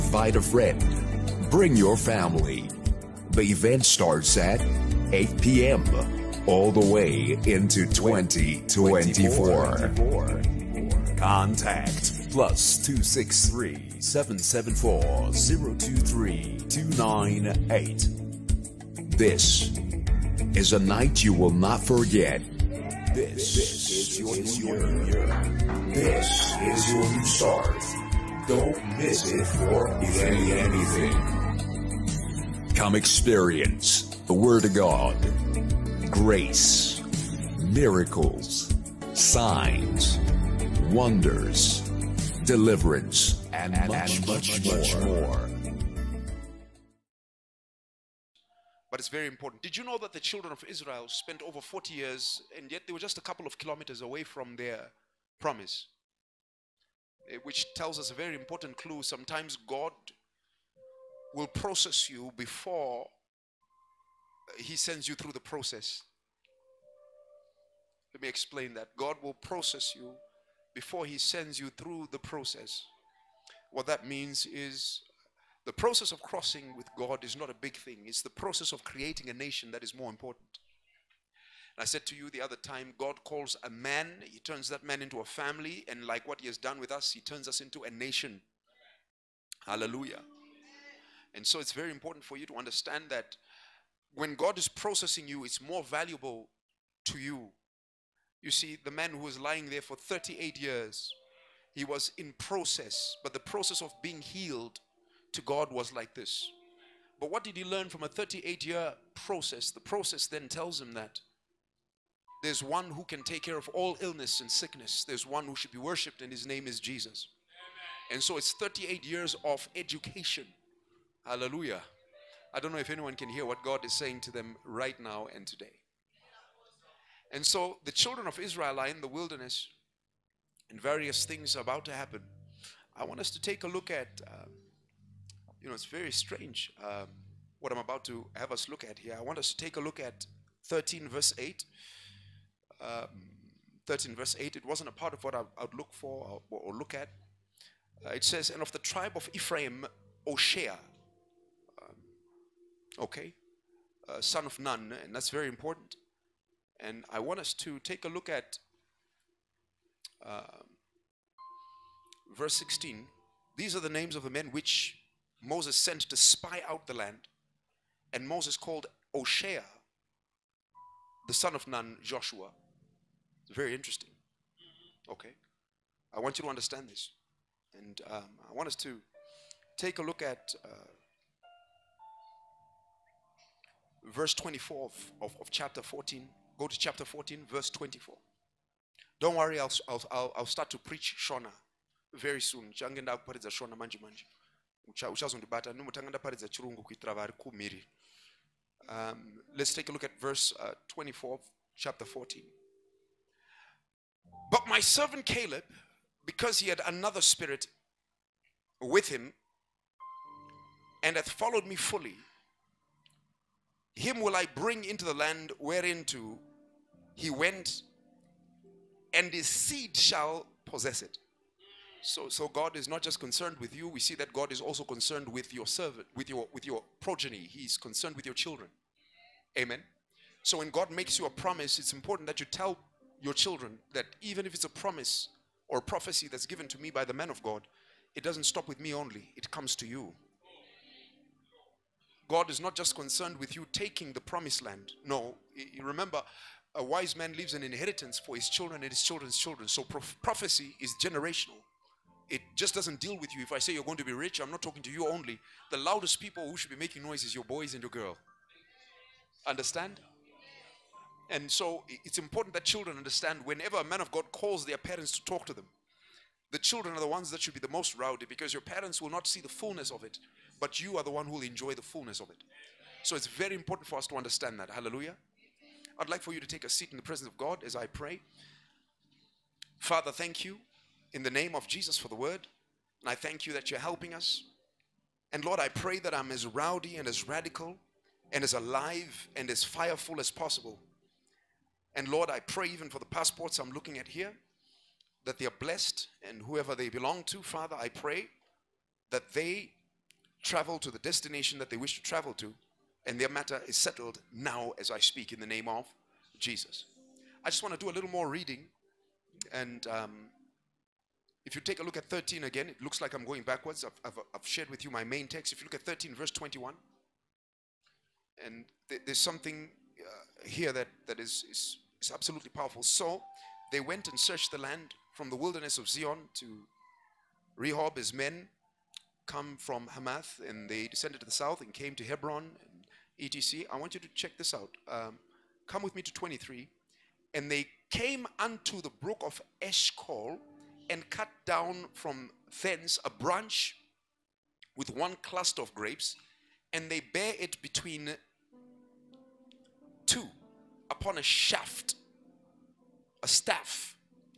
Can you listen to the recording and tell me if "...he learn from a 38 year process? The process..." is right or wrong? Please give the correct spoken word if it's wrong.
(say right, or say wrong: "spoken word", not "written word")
right.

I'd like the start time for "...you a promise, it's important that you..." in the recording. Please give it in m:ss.
3:51.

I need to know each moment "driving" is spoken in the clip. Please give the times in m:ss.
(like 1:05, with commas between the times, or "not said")
not said.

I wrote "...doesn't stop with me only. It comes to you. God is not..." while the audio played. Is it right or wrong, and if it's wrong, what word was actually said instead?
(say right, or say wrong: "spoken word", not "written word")
right.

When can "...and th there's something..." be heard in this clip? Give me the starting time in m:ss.
5:18.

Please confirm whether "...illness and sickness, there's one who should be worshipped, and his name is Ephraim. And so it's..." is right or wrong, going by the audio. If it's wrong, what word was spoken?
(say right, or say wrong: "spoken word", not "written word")
wrong: "Jesus", not "Ephraim".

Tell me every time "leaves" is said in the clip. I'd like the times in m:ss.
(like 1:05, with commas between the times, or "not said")
4:07.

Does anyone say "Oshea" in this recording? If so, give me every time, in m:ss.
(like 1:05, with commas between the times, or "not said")
2:30, 2:49.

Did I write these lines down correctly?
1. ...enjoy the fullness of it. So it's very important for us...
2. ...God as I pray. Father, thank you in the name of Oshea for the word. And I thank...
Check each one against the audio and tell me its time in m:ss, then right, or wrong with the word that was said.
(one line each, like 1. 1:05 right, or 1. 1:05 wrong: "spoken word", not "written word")
1. 4:31 right
2. 4:37 wrong: "Jesus", not "Oshea".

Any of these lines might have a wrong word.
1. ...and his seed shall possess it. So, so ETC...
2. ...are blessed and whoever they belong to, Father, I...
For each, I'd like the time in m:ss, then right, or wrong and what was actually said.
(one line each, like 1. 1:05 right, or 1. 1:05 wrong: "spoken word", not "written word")
1. 3:39 wrong: "God", not "ETC"
2. 4:55 right.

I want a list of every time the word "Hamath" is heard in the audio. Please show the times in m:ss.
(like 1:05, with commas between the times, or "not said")
5:29.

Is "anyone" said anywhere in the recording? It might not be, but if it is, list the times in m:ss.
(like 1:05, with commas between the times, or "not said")
2:02.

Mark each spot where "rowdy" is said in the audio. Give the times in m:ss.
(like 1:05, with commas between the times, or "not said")
4:27, 4:46.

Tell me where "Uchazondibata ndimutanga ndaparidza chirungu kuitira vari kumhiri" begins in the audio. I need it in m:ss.
3:15.